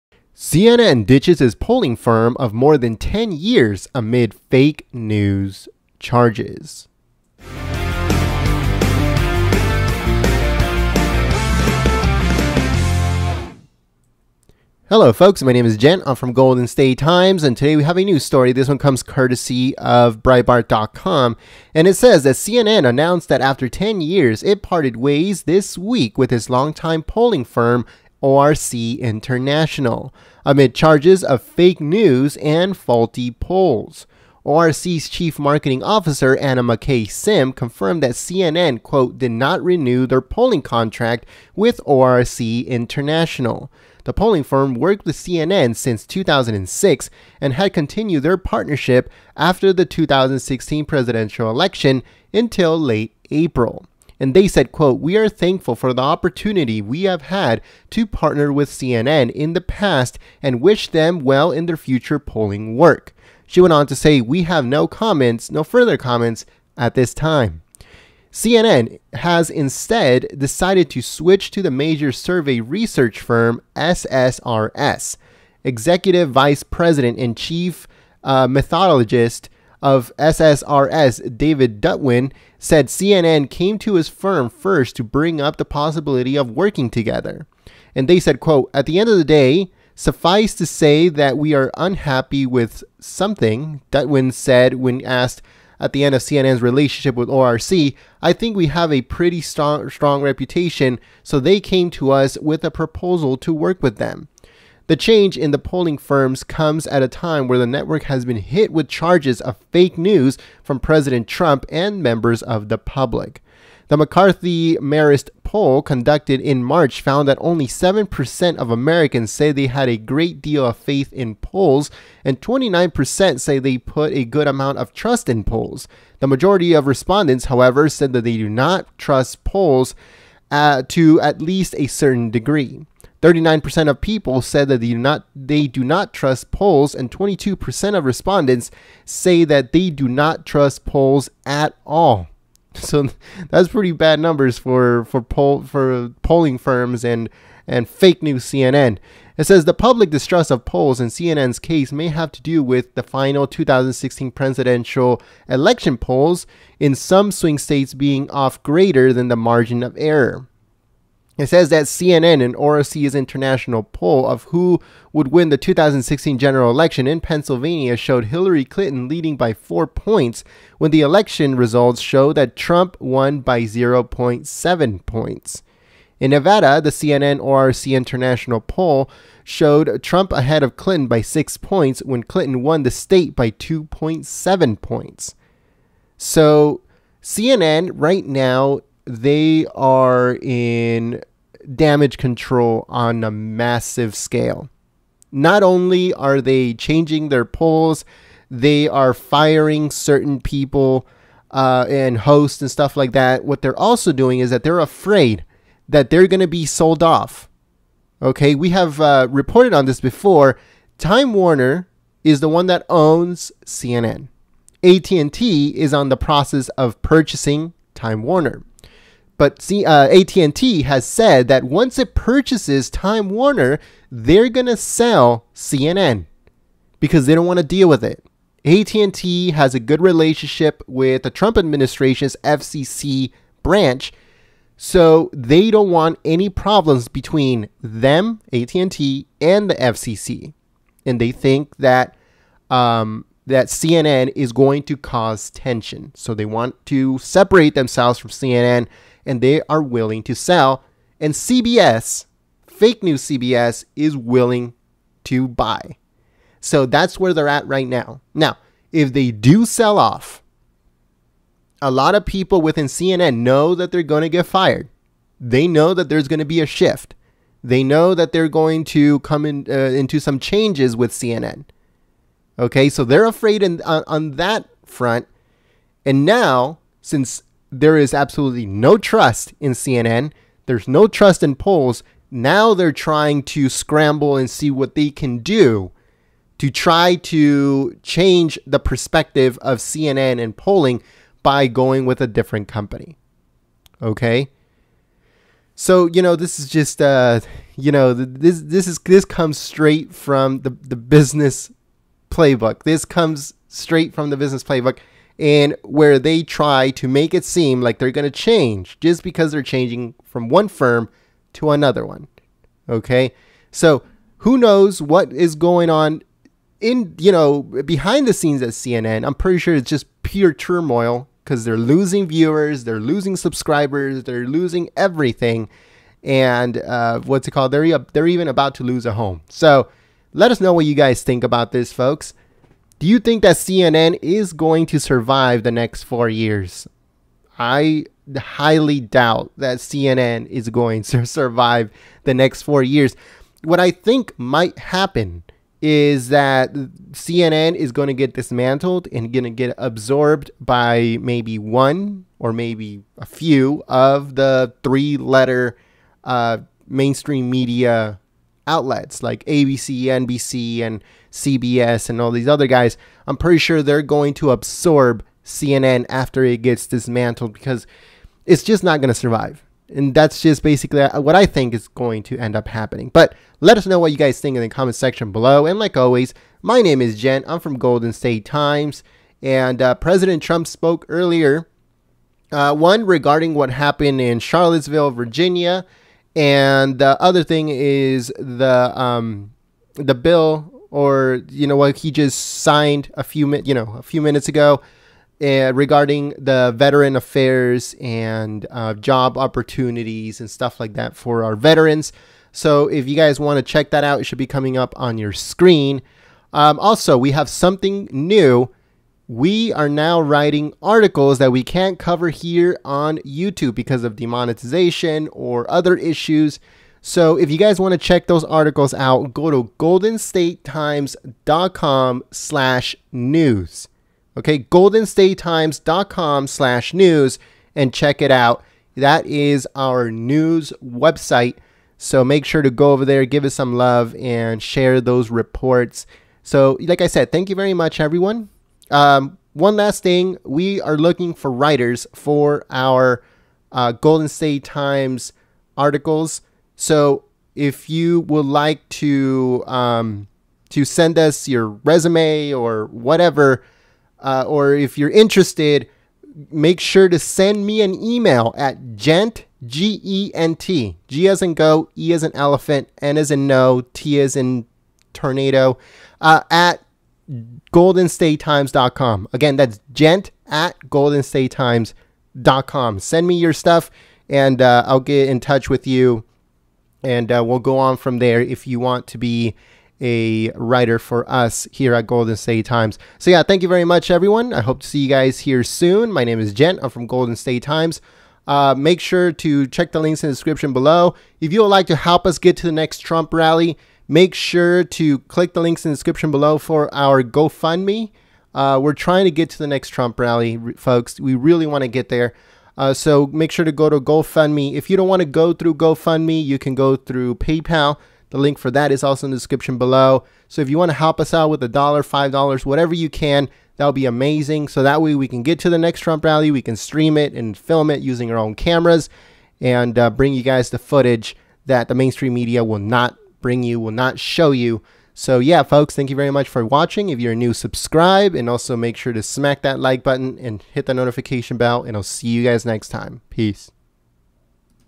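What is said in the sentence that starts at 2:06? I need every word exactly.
The majority of respondents, however, said that they do not trust polls uh, to at least a certain degree.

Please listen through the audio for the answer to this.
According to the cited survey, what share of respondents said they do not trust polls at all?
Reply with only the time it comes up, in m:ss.
2:17.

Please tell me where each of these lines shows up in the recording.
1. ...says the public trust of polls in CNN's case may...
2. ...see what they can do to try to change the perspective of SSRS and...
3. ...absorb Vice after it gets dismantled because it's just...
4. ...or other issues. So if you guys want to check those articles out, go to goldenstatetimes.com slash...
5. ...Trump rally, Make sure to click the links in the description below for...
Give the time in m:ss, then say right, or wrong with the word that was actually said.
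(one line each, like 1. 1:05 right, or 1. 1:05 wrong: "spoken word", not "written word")
1. 2:29 wrong: "distrust", not "trust"
2. 4:44 wrong: "CNN", not "SSRS"
3. 6:04 wrong: "CNN", not "Vice"
4. 6:55 right
5. 8:12 right.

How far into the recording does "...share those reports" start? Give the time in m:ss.
7:14.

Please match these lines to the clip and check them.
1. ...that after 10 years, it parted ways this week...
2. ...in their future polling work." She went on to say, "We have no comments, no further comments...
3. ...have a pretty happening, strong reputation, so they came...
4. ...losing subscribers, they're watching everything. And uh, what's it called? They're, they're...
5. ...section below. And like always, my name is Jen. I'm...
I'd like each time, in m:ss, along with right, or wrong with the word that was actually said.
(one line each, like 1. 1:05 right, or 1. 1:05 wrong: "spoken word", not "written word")
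1. 0:23 right
2. 1:01 right
3. 1:38 wrong: "strong", not "happening"
4. 5:22 wrong: "losing", not "watching"
5. 6:14 right.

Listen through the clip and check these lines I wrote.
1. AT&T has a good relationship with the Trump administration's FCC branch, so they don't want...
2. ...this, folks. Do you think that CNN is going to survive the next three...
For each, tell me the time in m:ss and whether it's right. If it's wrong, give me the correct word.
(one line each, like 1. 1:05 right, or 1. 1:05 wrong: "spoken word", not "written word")
1. 3:48 right
2. 5:31 wrong: "four", not "three".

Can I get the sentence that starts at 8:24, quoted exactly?
If you don't want to go through GoFundMe, you can go through PayPal.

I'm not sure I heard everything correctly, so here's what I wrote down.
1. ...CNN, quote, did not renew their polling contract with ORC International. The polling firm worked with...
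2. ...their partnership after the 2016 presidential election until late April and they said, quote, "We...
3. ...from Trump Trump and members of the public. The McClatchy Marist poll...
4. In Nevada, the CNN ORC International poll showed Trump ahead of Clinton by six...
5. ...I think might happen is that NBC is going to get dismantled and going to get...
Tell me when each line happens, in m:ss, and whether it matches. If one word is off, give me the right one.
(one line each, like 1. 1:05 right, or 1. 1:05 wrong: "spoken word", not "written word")
1. 0:38 right
2. 0:48 right
3. 1:50 wrong: "President", not "Trump"
4. 2:56 right
5. 5:43 wrong: "CNN", not "NBC".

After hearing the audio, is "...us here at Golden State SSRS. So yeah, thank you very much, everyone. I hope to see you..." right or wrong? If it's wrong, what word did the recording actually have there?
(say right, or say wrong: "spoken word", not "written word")
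wrong: "Times", not "SSRS".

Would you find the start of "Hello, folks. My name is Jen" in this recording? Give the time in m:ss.
0:14.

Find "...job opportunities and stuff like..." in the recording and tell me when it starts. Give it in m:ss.
6:38.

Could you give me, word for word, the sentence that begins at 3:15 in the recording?
Not only are they changing their polls, they are firing certain people uh, and hosts and stuff like that.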